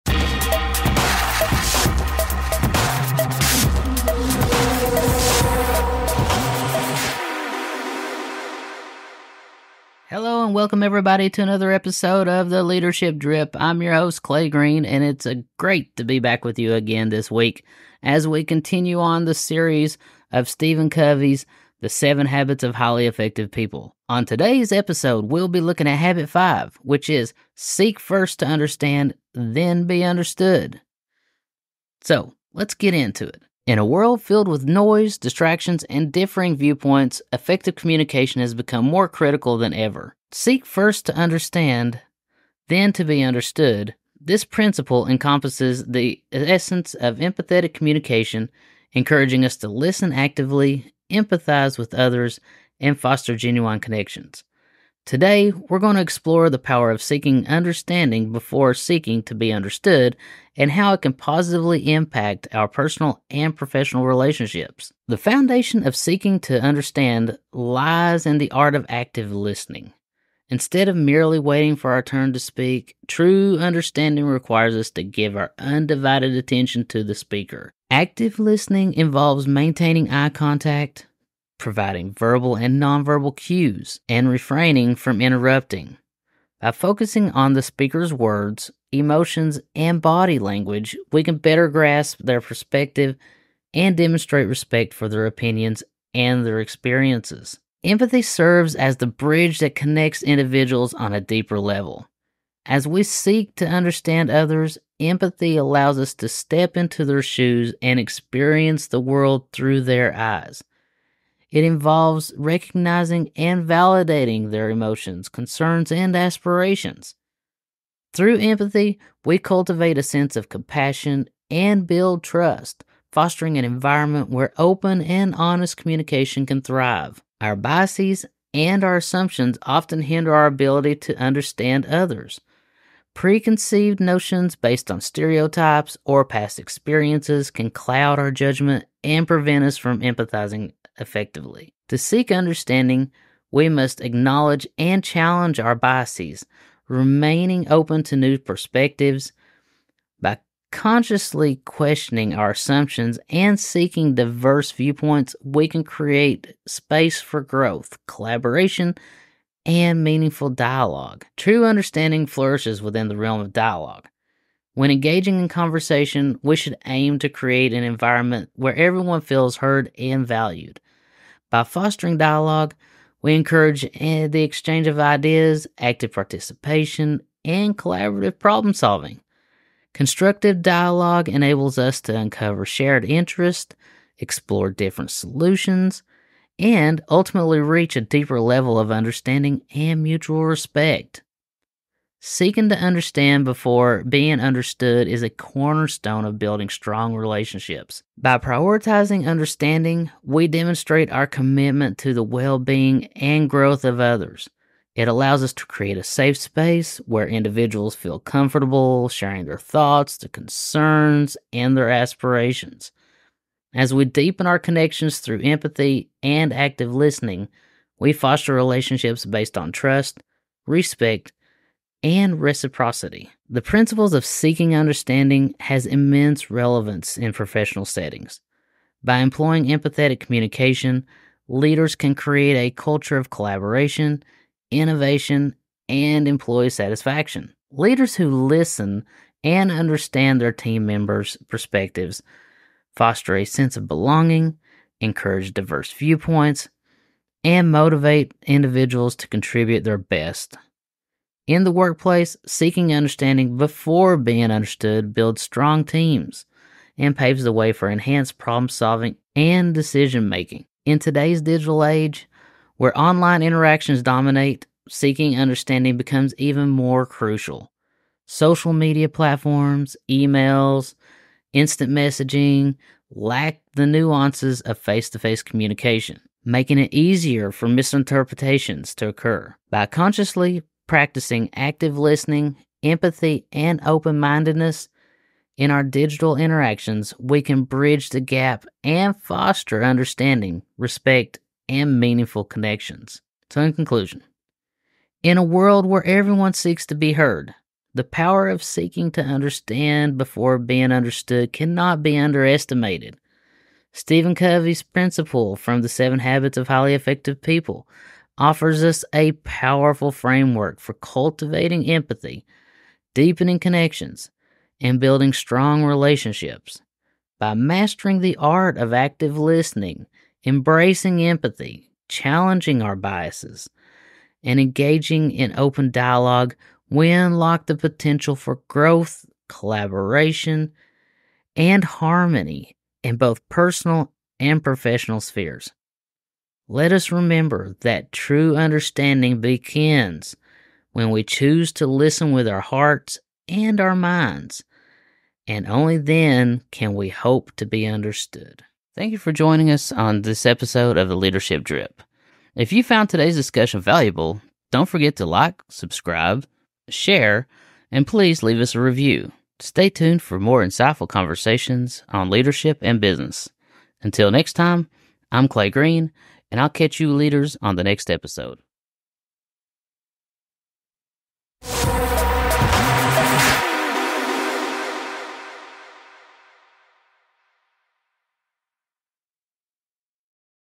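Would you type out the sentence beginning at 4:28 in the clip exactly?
Social media platforms, emails, instant messaging lack the nuances of face to face communication, making it easier for misinterpretations to occur.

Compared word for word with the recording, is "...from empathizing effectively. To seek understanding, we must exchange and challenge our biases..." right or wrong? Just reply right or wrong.
wrong.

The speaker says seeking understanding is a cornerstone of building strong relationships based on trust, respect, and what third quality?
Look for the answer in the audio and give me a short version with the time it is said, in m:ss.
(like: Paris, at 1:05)
reciprocity, at 3:42.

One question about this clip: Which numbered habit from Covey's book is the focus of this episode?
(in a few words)
habit five.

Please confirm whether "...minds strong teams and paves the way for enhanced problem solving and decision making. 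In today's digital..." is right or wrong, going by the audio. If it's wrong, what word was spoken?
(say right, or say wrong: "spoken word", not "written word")
wrong: "builds", not "minds".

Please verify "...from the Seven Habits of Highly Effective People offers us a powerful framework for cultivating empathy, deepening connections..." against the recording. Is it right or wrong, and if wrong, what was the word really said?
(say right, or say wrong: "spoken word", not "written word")
right.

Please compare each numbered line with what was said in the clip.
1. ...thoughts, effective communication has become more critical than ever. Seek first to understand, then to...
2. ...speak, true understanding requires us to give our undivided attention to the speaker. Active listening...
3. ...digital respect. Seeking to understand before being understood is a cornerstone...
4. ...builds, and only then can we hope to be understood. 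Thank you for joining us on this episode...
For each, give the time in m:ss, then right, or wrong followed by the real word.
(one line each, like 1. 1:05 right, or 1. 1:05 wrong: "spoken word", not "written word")
1. 0:36 wrong: "viewpoints", not "thoughts"
2. 1:12 right
3. 3:10 wrong: "mutual", not "digital"
4. 5:43 wrong: "minds", not "builds".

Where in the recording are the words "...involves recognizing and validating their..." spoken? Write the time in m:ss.
1:51.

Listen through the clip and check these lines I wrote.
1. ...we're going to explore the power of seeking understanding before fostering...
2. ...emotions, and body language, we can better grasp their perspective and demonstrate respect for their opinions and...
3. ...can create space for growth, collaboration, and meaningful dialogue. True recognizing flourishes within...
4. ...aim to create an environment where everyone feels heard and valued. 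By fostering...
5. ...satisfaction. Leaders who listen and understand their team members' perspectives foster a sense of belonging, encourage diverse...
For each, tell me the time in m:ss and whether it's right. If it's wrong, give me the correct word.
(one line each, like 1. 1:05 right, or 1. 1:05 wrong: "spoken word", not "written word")
1. 0:55 wrong: "seeking", not "fostering"
2. 1:28 right
3. 2:35 wrong: "understanding", not "recognizing"
4. 2:46 right
5. 3:56 right.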